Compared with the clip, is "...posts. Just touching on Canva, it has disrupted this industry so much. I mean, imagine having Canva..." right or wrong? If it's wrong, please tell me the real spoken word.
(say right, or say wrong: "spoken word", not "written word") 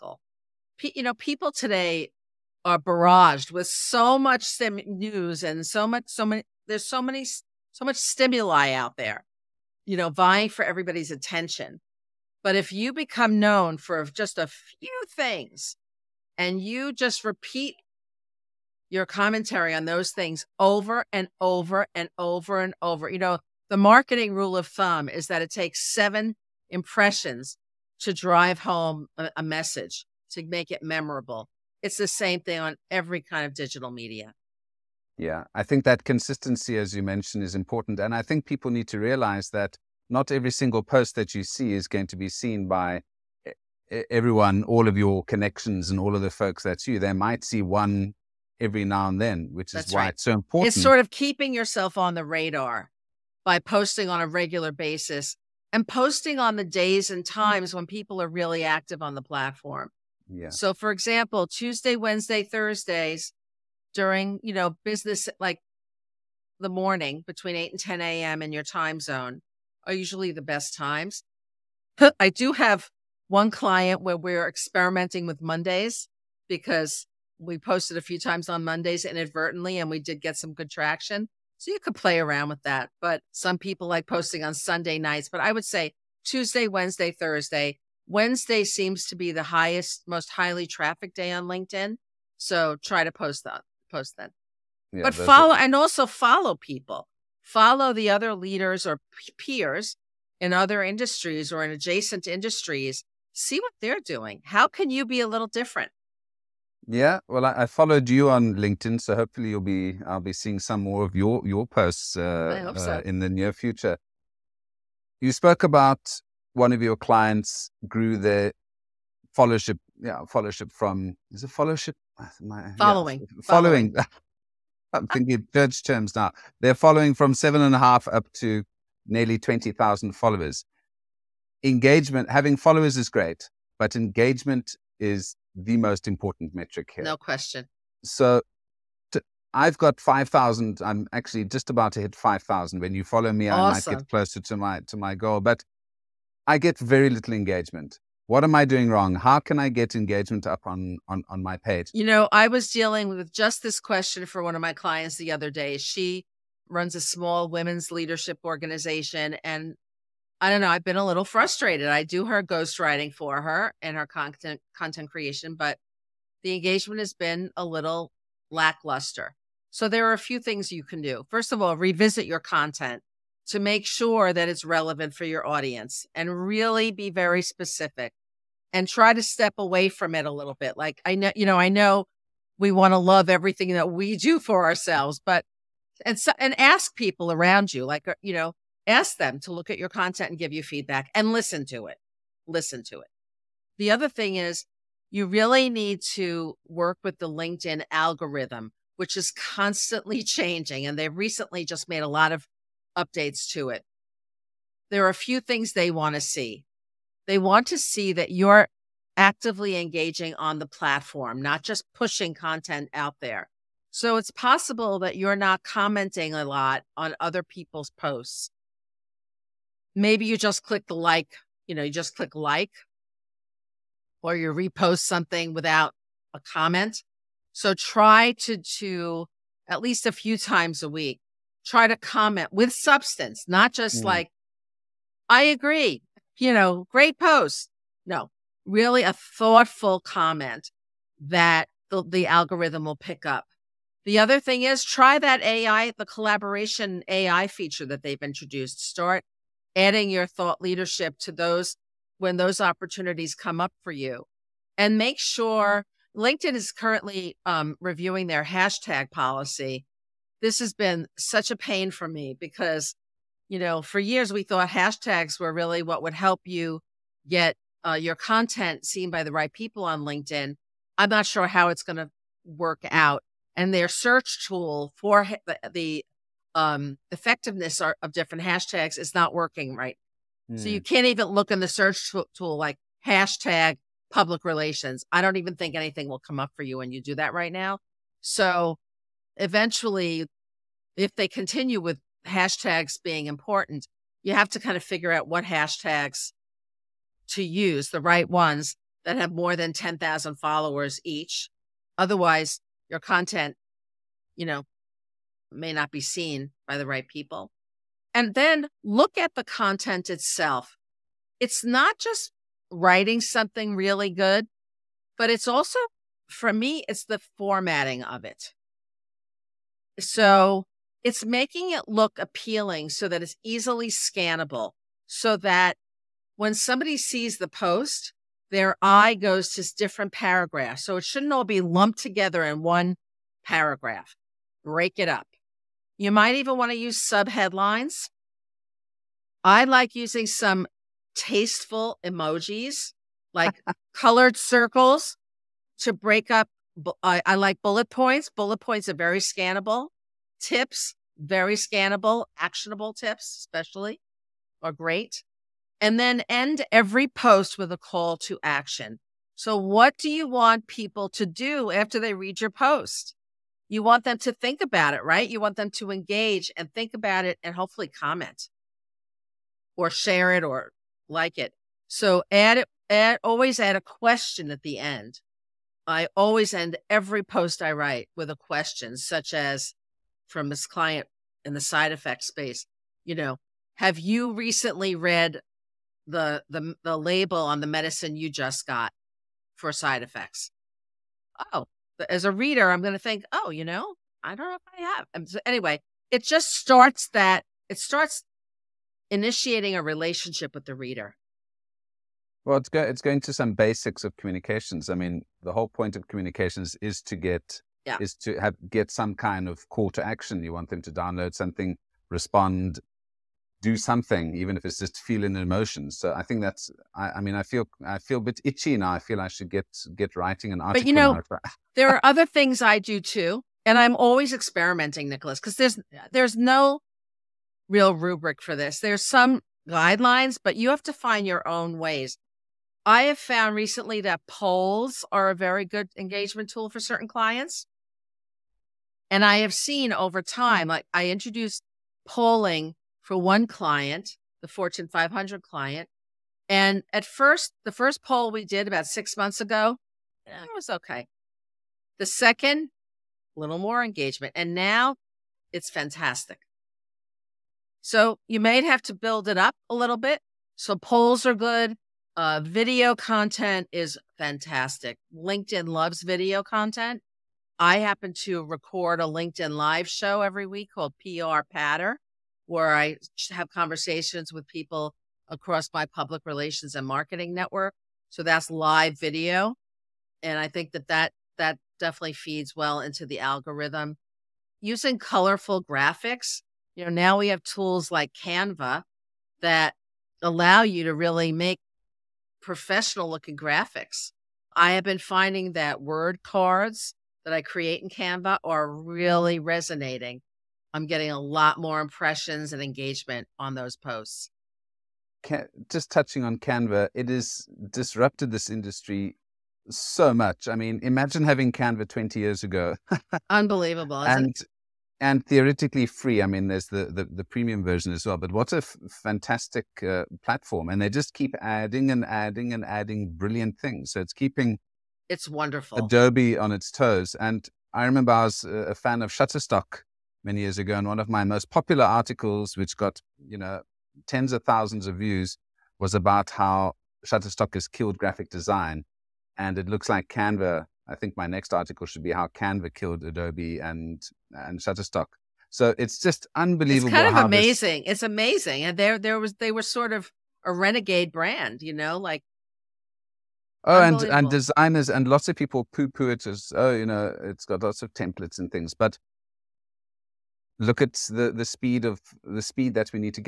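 right.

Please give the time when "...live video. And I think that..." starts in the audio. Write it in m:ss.
7:58.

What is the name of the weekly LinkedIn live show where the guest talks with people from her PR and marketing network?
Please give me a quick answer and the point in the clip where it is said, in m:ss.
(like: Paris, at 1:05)
PR Patter, at 7:51.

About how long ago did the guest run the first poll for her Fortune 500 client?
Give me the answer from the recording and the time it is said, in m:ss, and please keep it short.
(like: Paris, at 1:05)
6 months, at 7:28.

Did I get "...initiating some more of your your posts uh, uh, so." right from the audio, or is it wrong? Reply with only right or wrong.
wrong.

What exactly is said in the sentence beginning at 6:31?
Oh, as a reader, I'm going to think, oh, you know, I don't know if I have.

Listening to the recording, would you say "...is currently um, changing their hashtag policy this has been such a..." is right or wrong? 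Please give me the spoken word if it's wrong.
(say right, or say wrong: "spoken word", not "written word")
wrong: "reviewing", not "changing".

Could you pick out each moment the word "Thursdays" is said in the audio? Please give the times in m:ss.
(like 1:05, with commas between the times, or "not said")
1:02, 1:27.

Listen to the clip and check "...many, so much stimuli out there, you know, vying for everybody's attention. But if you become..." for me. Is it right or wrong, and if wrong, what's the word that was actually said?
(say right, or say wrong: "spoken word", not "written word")
right.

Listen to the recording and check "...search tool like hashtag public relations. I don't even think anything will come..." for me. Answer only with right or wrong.
right.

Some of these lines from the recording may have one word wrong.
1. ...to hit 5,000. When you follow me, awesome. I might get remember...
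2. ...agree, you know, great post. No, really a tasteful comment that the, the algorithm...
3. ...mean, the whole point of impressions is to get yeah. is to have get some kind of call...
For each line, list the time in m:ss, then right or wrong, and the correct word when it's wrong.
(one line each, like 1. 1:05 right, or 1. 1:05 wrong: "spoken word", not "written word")
1. 2:21 wrong: "closer", not "remember"
2. 3:55 wrong: "thoughtful", not "tasteful"
3. 6:44 wrong: "communications", not "impressions".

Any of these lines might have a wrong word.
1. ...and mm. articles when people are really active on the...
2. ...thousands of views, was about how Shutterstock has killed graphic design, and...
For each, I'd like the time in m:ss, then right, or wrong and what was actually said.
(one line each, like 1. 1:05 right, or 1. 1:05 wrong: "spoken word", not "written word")
1. 0:57 wrong: "times", not "articles"
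2. 8:54 right.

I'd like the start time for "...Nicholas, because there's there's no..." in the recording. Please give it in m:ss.
7:05.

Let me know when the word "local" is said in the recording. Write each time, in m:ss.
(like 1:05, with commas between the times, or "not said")
not said.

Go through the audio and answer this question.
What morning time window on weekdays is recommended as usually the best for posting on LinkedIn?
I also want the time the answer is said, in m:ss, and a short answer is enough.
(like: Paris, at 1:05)
8 to 10 a.m., at 1:07.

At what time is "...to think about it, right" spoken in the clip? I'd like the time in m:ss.
6:04.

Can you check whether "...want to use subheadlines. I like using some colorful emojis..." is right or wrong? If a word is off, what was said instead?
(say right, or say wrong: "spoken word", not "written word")
wrong: "tasteful", not "colorful".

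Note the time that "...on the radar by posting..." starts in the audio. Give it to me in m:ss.
0:51.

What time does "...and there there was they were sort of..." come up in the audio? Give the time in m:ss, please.
9:08.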